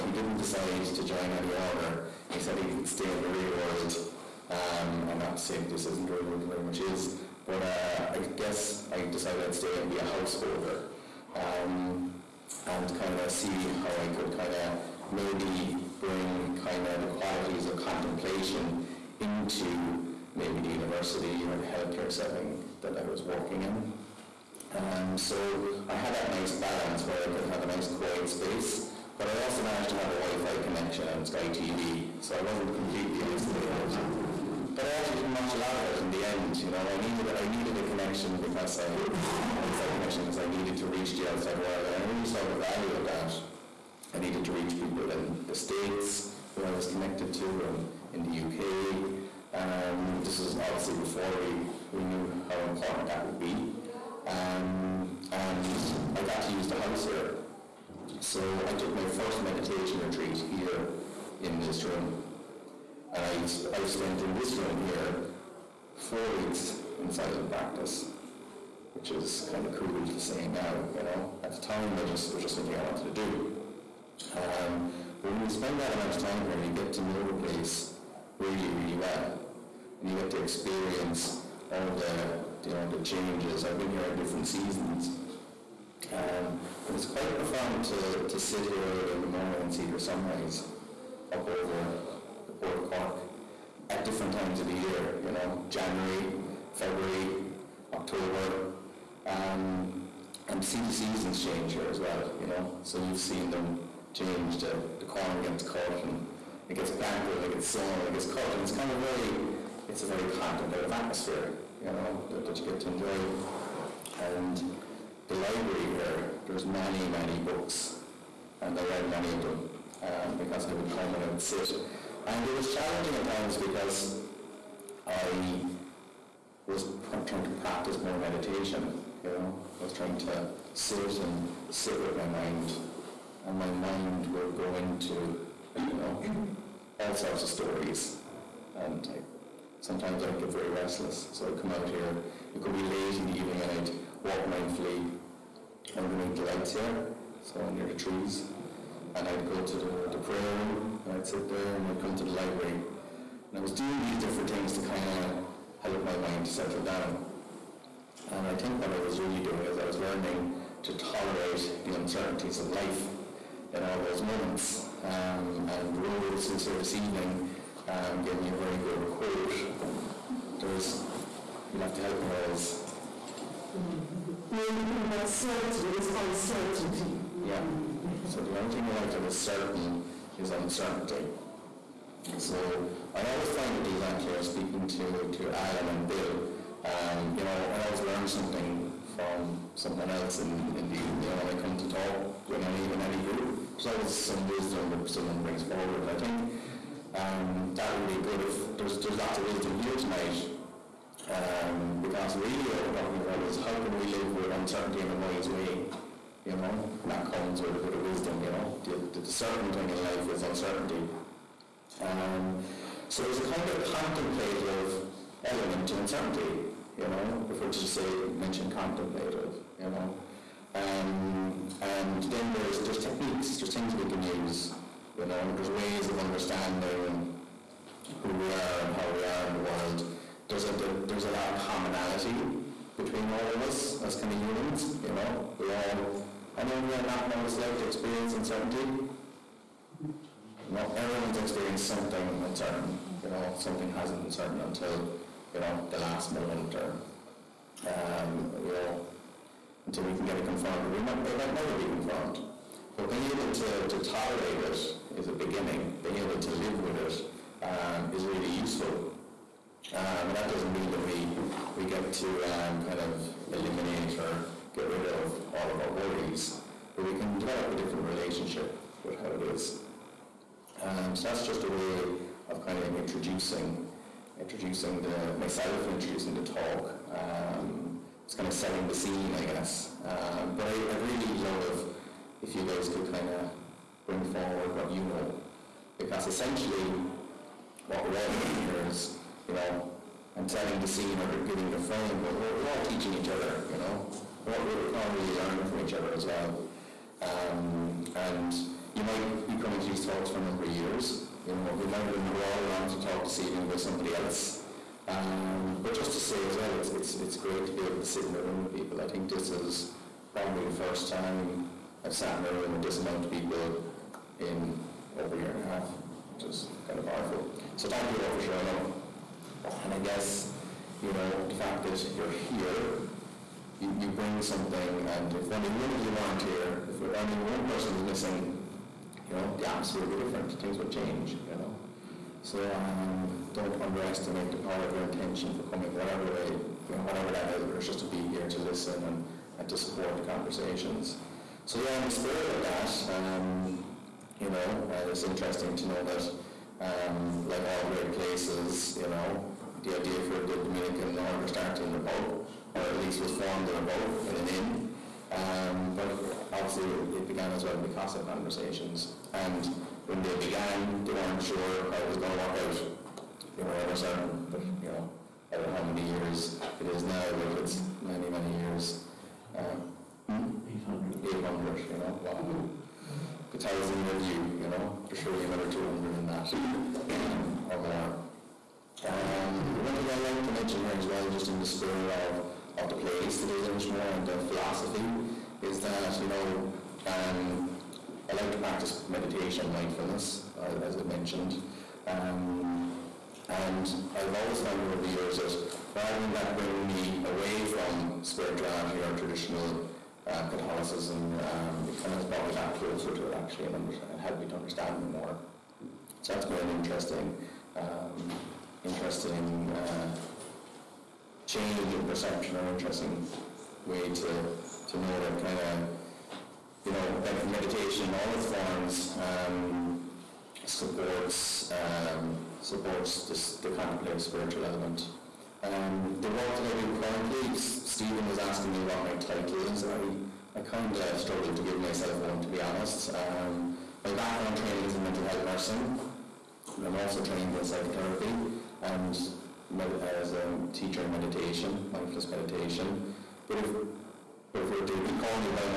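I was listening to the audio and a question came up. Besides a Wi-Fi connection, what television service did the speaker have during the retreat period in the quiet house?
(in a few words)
Sky TV.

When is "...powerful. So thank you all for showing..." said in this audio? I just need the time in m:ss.
5:17.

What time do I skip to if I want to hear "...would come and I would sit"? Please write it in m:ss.
2:00.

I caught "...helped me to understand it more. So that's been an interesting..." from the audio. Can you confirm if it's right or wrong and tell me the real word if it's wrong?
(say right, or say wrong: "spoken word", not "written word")
right.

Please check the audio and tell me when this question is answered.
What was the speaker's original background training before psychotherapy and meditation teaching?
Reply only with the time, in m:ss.
7:15.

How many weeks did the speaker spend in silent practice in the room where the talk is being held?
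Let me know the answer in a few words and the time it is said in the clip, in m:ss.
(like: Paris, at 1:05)
4, at 1:06.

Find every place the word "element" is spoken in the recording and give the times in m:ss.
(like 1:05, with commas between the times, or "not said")
3:35, 7:04.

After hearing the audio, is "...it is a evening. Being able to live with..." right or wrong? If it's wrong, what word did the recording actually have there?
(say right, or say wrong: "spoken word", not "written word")
wrong: "beginning", not "evening".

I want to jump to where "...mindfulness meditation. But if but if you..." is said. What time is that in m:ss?
7:21.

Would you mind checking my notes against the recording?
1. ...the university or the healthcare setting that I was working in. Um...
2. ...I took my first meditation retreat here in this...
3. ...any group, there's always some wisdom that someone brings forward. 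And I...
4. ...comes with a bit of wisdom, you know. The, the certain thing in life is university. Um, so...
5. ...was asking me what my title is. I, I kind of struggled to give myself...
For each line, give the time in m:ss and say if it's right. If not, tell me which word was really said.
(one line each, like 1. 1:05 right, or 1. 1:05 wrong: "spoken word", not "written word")
1. 0:20 right
2. 0:58 right
3. 3:12 right
4. 3:27 wrong: "uncertainty", not "university"
5. 7:08 right.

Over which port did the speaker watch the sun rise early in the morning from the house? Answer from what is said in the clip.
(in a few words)
Cork.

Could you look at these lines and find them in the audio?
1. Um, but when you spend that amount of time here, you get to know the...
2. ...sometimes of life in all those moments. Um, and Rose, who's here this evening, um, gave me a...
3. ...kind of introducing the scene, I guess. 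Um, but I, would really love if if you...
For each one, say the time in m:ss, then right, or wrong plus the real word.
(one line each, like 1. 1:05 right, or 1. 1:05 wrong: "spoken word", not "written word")
1. 1:14 right
2. 2:41 wrong: "uncertainties", not "sometimes"
3. 4:38 wrong: "setting", not "introducing".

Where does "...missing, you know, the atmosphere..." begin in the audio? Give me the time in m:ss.
5:28.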